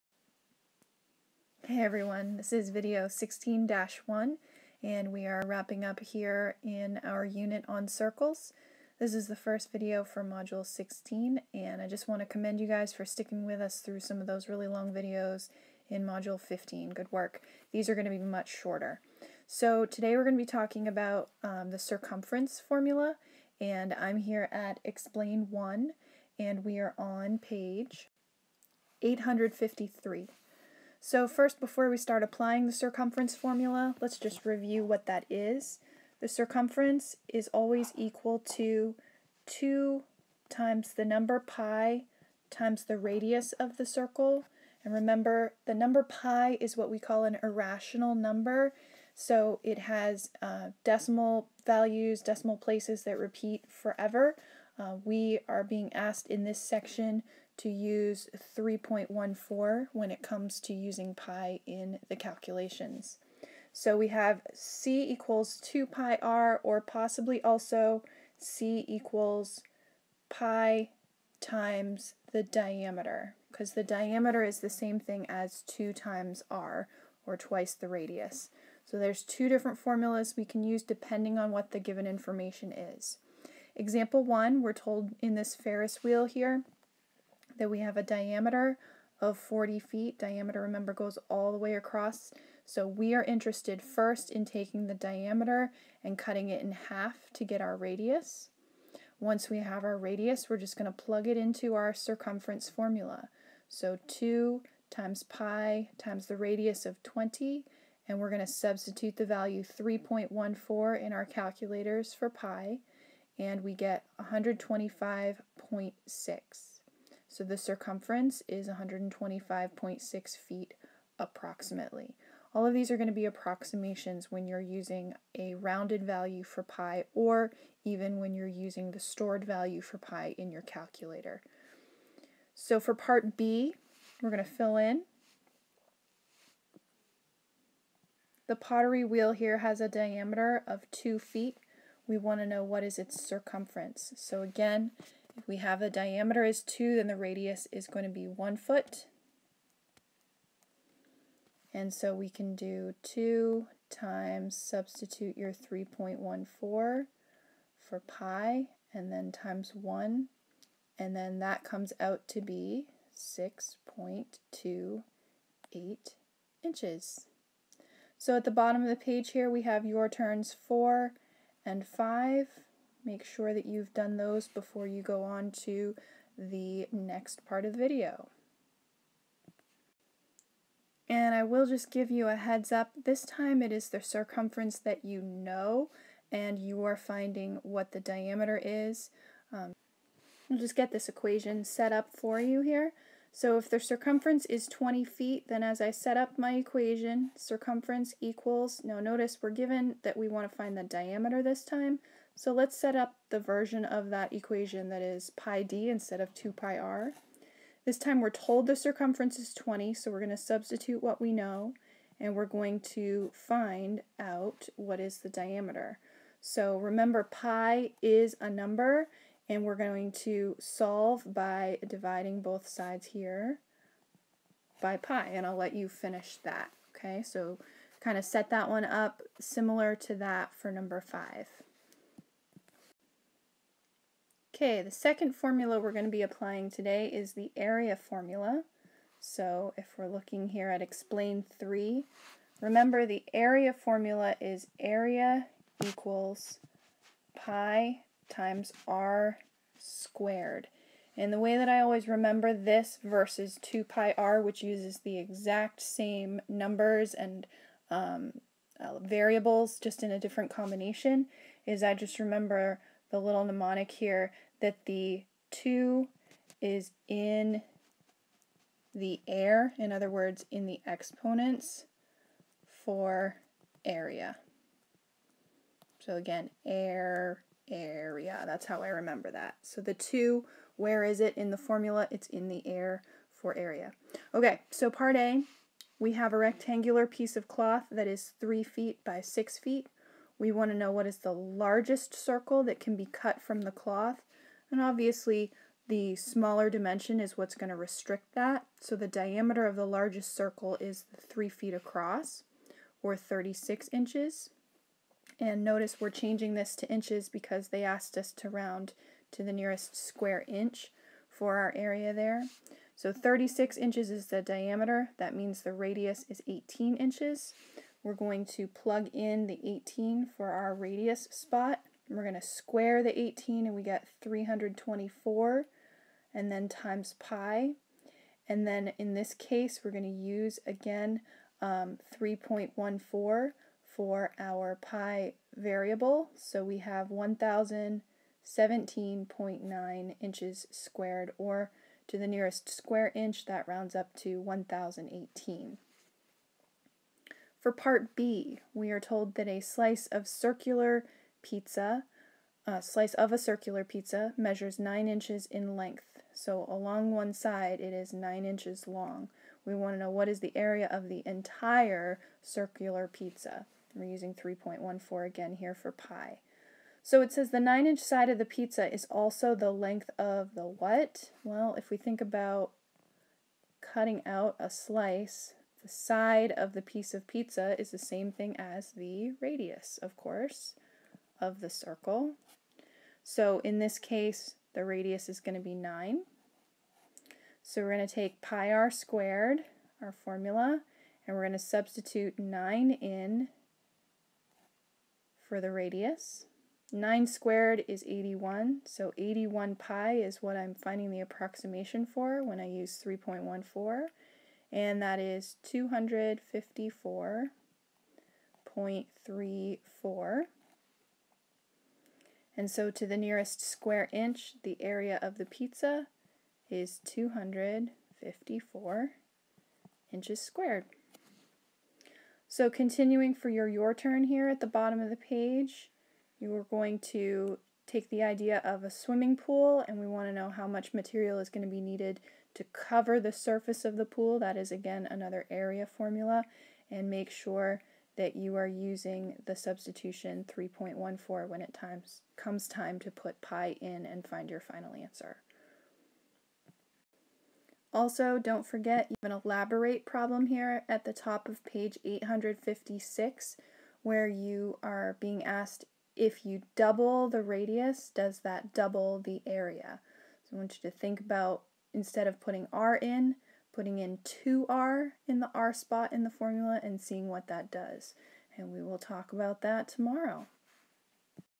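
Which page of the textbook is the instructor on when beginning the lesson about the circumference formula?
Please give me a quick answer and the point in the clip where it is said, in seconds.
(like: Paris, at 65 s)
853, at 27 s.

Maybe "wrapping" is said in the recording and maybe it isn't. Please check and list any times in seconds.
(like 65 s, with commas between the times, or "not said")
5 s.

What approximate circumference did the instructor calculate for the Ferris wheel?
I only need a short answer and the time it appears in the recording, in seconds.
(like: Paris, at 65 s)
125.6 feet, at 118 s.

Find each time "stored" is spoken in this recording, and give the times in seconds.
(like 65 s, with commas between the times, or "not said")
128 s.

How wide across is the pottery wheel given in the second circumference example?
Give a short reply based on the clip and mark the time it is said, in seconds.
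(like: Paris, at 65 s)
2 feet, at 140 s.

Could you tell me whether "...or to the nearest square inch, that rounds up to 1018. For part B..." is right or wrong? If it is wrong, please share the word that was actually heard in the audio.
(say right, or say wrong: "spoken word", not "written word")
right.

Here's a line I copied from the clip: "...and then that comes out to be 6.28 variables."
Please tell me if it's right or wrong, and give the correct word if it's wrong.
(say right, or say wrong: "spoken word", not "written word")
wrong: "inches", not "variables".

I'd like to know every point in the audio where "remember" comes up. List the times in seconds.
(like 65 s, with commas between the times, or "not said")
44 s, 90 s, 216 s, 242 s, 252 s, 262 s, 278 s.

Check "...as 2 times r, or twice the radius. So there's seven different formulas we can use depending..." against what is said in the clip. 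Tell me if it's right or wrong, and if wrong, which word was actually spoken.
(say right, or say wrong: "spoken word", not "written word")
wrong: "two", not "seven".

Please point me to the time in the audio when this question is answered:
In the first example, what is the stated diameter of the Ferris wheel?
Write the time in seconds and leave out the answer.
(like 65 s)
89 s.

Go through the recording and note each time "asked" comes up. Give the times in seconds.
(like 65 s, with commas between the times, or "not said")
55 s, 307 s, 455 s.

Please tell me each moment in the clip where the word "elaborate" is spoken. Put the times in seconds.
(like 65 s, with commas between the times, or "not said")
449 s.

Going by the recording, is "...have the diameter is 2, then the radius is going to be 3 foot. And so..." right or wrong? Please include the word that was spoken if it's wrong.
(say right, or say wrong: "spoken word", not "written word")
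wrong: "1", not "3".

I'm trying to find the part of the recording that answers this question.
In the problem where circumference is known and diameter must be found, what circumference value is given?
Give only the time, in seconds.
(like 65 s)
194 s.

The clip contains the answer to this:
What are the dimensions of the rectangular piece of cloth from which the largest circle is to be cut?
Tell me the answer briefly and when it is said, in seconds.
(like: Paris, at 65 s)
3 feet by 6 feet, at 288 s.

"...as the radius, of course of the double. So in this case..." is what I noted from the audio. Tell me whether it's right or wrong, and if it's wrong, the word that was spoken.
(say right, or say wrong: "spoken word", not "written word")
wrong: "circle", not "double".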